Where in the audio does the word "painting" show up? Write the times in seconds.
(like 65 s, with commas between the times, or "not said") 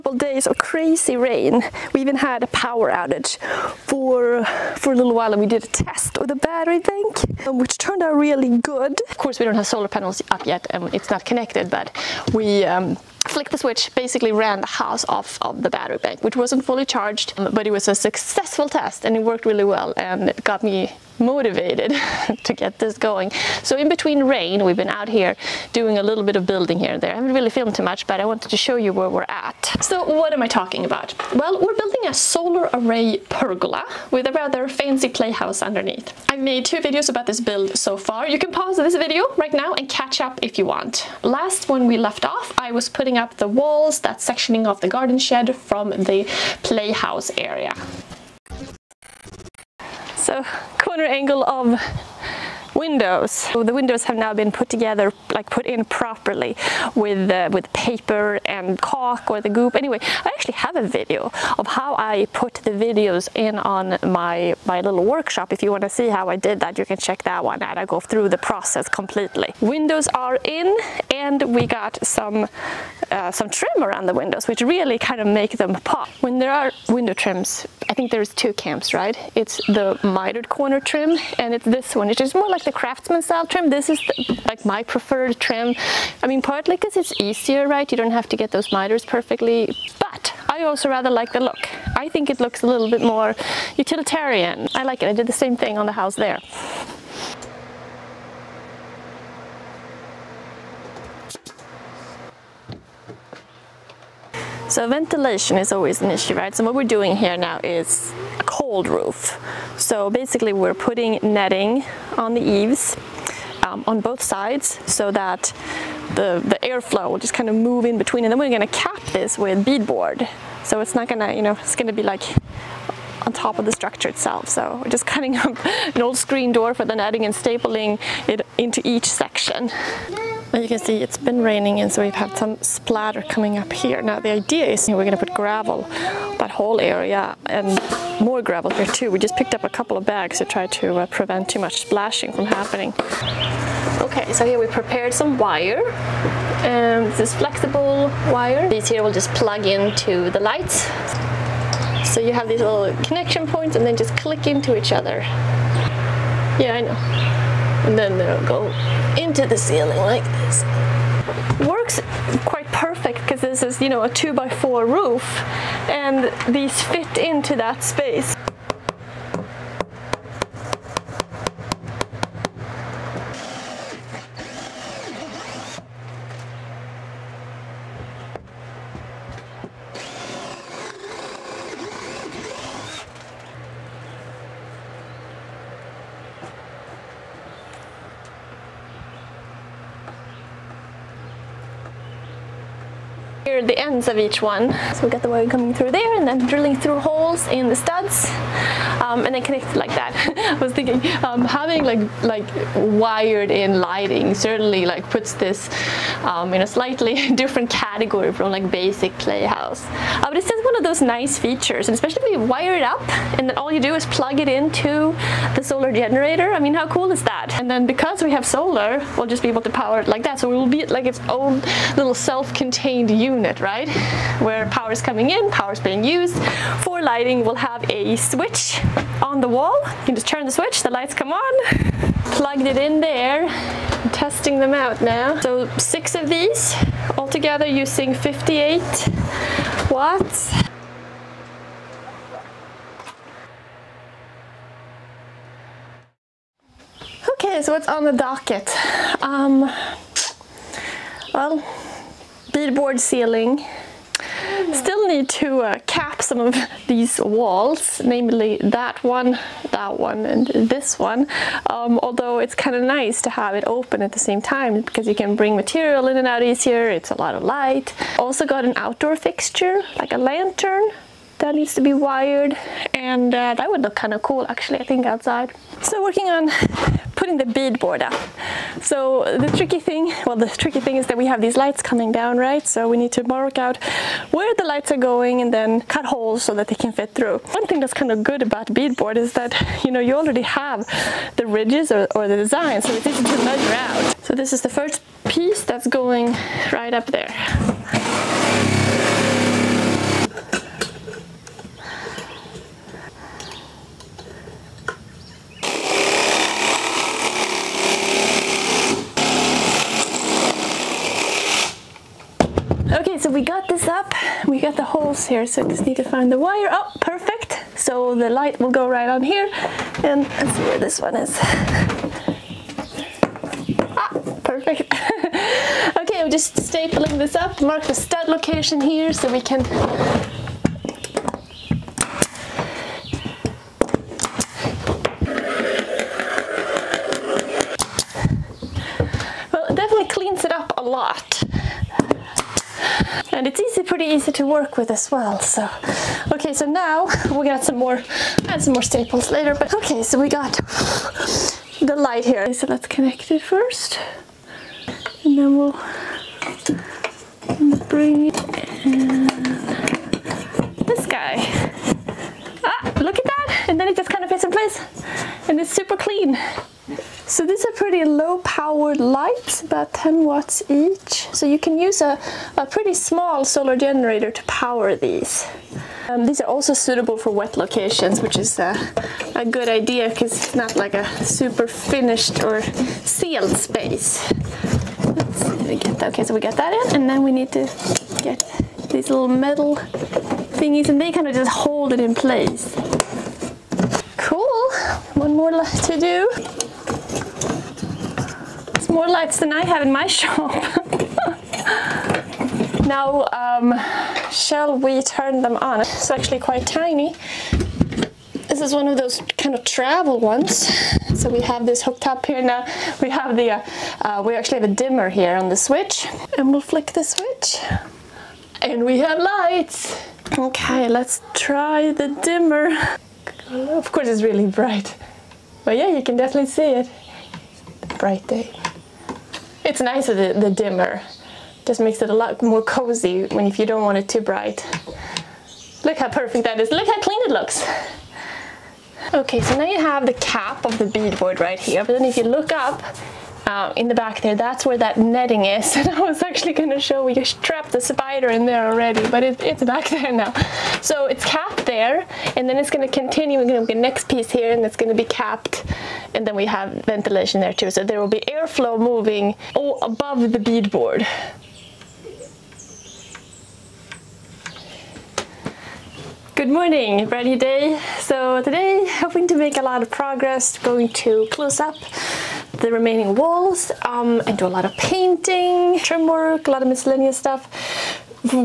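474 s.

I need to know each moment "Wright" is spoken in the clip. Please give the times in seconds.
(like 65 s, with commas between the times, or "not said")
not said.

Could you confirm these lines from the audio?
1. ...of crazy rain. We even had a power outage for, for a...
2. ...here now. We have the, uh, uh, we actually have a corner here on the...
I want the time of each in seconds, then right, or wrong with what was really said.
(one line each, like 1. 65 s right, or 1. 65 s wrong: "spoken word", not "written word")
1. 0 s right
2. 412 s wrong: "dimmer", not "corner".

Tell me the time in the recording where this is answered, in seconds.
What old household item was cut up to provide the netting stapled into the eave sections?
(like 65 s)
126 s.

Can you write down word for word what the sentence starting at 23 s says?
So in between rain, we've been out here doing a little bit of building here and there.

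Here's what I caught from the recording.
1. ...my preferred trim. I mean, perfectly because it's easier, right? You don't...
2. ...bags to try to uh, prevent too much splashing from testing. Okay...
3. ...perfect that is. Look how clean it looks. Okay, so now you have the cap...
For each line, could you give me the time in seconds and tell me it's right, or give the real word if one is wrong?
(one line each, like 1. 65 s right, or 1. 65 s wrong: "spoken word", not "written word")
1. 84 s wrong: "partly", not "perfectly"
2. 140 s wrong: "happening", not "testing"
3. 436 s right.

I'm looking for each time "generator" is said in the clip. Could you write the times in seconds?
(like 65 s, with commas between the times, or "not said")
215 s, 373 s.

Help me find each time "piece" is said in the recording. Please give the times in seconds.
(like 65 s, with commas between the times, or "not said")
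295 s, 454 s.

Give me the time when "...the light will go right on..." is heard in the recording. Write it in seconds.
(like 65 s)
318 s.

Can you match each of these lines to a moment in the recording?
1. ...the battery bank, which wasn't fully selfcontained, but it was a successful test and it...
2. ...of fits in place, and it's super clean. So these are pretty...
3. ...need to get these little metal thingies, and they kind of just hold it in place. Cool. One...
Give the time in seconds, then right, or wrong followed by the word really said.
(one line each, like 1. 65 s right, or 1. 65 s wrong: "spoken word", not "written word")
1. 15 s wrong: "charged", not "selfcontained"
2. 364 s right
3. 387 s right.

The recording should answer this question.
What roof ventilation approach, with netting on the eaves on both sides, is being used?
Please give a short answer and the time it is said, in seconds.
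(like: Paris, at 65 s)
cold roof, at 108 s.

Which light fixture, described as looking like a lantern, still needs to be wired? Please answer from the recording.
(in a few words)
outdoor fixture.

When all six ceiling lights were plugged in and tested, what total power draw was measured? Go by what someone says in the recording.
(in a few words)
58 watts.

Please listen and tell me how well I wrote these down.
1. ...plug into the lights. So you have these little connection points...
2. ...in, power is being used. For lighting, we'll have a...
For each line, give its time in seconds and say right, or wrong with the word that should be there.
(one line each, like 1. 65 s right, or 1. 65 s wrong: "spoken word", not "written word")
1. 149 s right
2. 225 s right.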